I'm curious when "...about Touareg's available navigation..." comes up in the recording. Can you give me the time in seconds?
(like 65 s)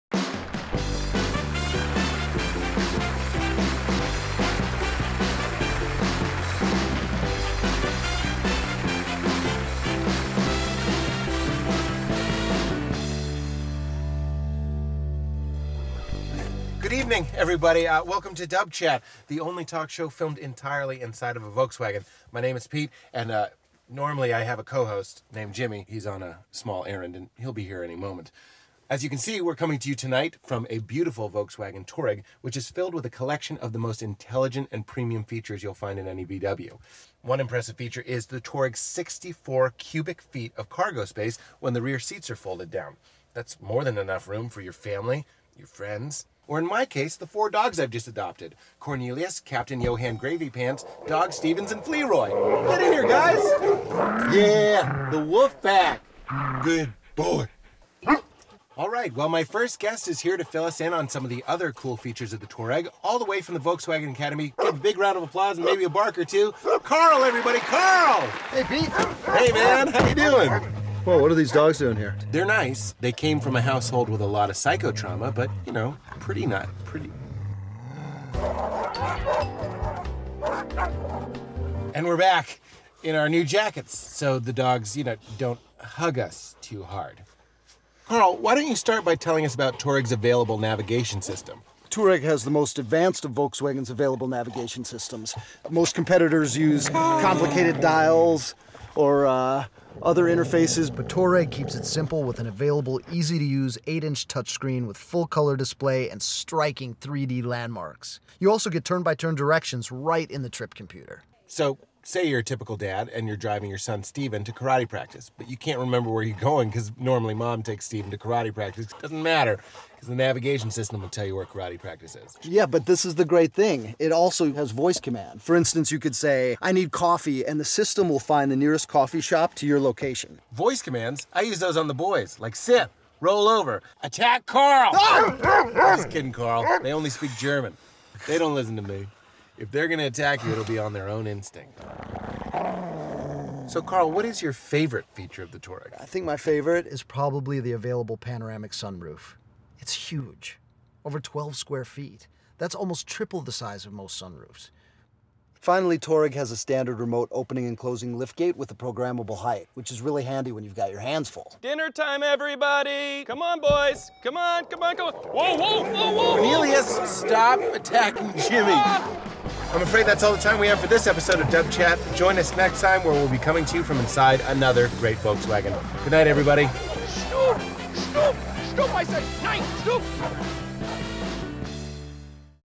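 89 s.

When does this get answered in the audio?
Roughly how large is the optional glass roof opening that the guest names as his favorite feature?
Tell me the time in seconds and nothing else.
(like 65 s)
151 s.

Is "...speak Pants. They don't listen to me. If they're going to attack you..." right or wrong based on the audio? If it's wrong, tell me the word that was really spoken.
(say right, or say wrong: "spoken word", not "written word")
wrong: "German", not "Pants".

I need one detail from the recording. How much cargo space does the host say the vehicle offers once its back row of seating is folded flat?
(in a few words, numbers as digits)
64 cubic feet.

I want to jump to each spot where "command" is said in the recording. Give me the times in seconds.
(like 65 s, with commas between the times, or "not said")
124 s, 130 s.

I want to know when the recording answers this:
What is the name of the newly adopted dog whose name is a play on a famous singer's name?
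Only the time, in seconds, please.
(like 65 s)
51 s.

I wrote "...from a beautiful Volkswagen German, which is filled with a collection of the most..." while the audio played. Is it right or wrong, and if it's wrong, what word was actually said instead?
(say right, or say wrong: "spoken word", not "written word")
wrong: "Touareg", not "German".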